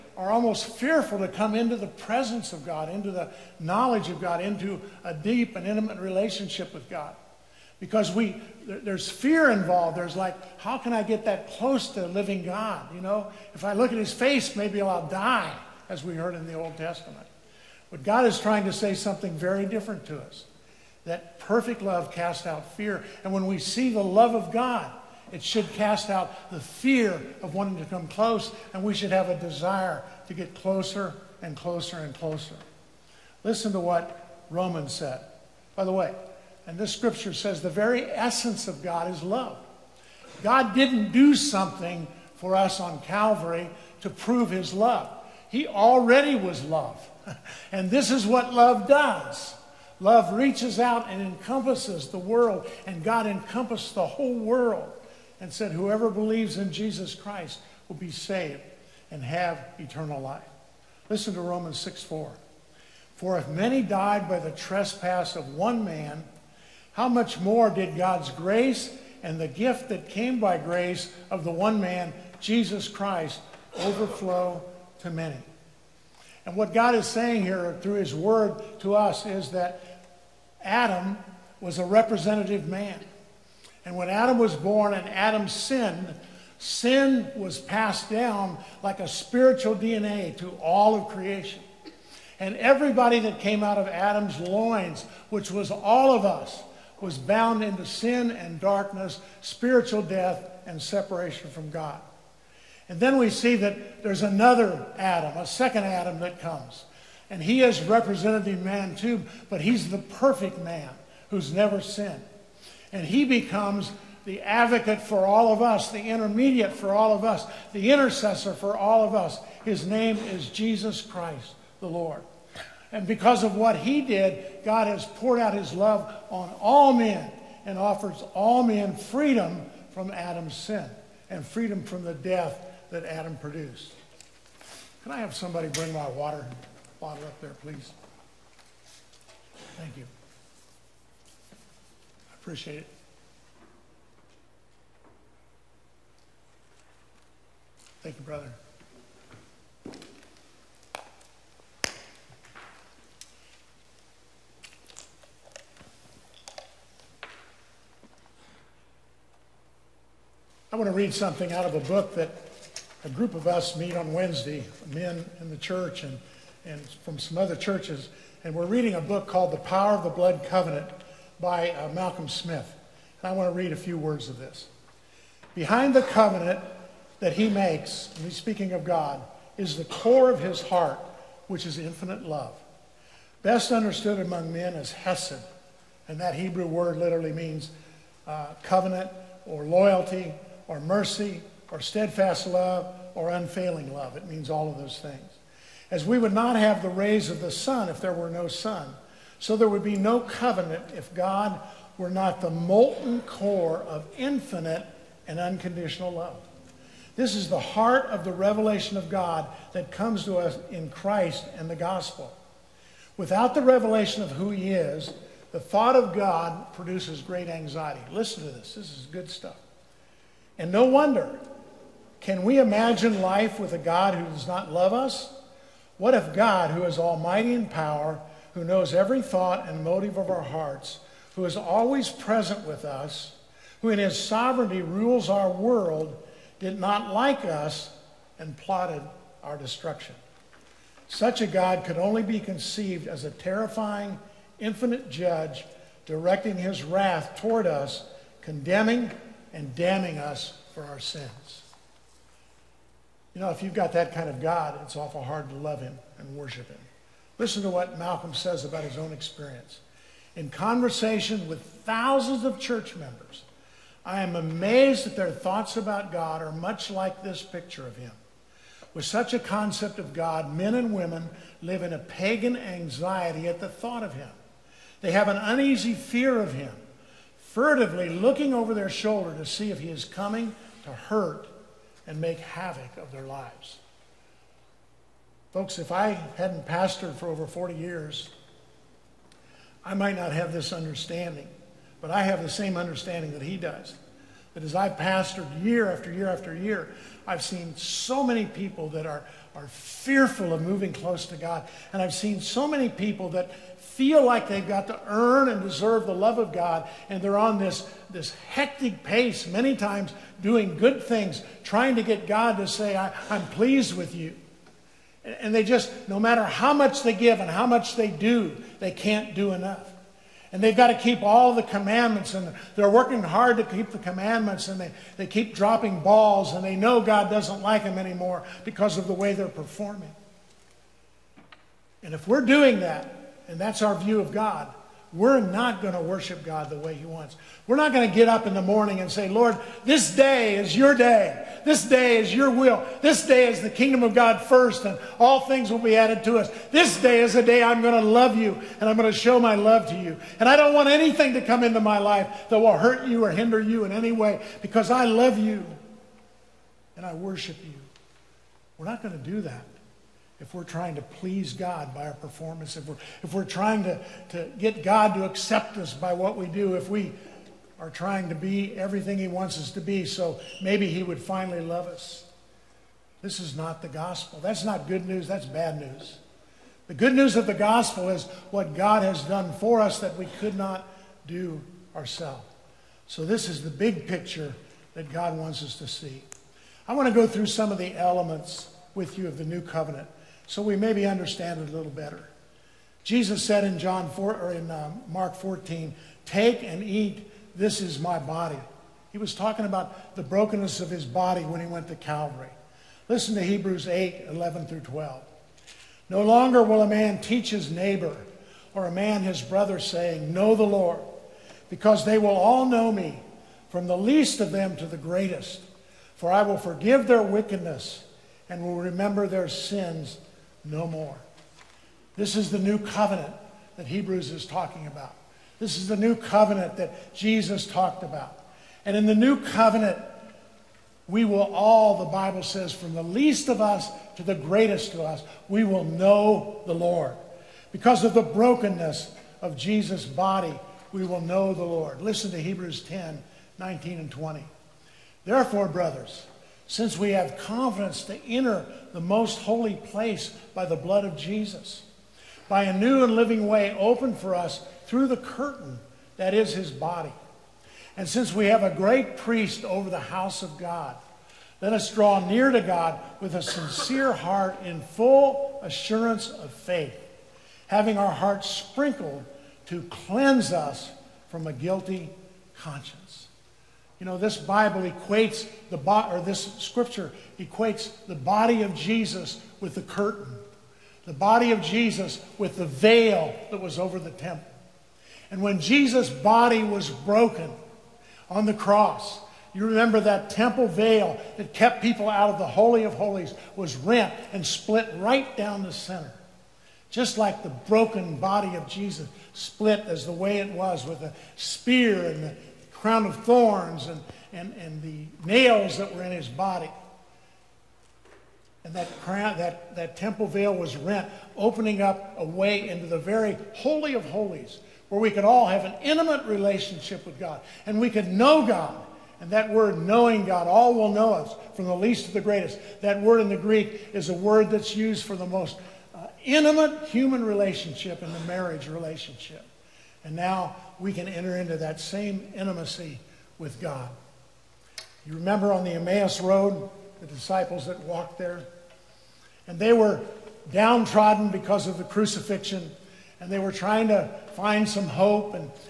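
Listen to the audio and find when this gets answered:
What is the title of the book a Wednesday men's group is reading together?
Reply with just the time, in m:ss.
2:49.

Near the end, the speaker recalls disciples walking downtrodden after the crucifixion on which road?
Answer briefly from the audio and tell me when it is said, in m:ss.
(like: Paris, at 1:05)
Emmaus Road, at 8:55.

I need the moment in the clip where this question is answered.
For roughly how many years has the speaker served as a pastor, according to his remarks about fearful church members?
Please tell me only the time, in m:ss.
4:47.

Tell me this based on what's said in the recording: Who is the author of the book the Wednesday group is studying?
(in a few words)
Malcolm Smith.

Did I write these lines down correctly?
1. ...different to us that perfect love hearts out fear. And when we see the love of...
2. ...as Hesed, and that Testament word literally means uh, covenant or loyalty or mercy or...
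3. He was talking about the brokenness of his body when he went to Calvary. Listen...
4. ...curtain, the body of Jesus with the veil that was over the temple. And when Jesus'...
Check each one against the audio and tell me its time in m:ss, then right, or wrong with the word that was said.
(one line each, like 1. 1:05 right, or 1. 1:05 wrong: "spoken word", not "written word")
1. 0:19 wrong: "casts", not "hearts"
2. 3:04 wrong: "Hebrew", not "Testament"
3. 6:39 right
4. 7:59 right.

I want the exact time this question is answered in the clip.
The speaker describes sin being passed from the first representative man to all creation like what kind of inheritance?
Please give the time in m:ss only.
1:29.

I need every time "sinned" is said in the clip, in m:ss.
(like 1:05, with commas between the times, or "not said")
1:25, 1:51.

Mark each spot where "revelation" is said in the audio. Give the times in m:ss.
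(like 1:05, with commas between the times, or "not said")
3:28, 3:33.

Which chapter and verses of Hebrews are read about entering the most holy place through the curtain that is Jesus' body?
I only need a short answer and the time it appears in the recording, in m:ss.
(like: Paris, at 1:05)
Hebrews 10:19-20, at 7:22.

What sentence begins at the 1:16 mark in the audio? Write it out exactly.
And what God is saying here through his word to us is that Adam was a representative man.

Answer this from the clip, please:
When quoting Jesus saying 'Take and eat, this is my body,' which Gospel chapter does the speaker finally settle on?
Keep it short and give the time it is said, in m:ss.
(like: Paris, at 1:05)
Mark 14, at 6:35.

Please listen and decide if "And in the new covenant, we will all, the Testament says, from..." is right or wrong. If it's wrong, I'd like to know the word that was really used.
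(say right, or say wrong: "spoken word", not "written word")
wrong: "Bible", not "Testament".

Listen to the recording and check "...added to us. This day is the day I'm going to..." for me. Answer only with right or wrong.
right.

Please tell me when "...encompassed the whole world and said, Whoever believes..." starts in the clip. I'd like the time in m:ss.
0:53.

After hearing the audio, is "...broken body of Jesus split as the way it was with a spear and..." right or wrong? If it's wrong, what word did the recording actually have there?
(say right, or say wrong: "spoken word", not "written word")
right.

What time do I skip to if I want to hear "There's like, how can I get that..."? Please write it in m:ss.
0:09.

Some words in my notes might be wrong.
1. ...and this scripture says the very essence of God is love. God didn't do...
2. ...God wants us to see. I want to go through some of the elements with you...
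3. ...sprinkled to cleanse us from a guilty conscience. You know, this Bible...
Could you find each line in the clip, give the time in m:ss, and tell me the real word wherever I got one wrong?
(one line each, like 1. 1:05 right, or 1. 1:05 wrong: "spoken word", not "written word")
1. 0:36 right
2. 6:25 right
3. 7:48 right.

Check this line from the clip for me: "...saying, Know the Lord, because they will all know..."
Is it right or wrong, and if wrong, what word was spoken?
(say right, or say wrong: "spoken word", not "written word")
right.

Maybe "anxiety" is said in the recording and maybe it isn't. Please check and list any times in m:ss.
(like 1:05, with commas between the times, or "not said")
3:37, 4:32.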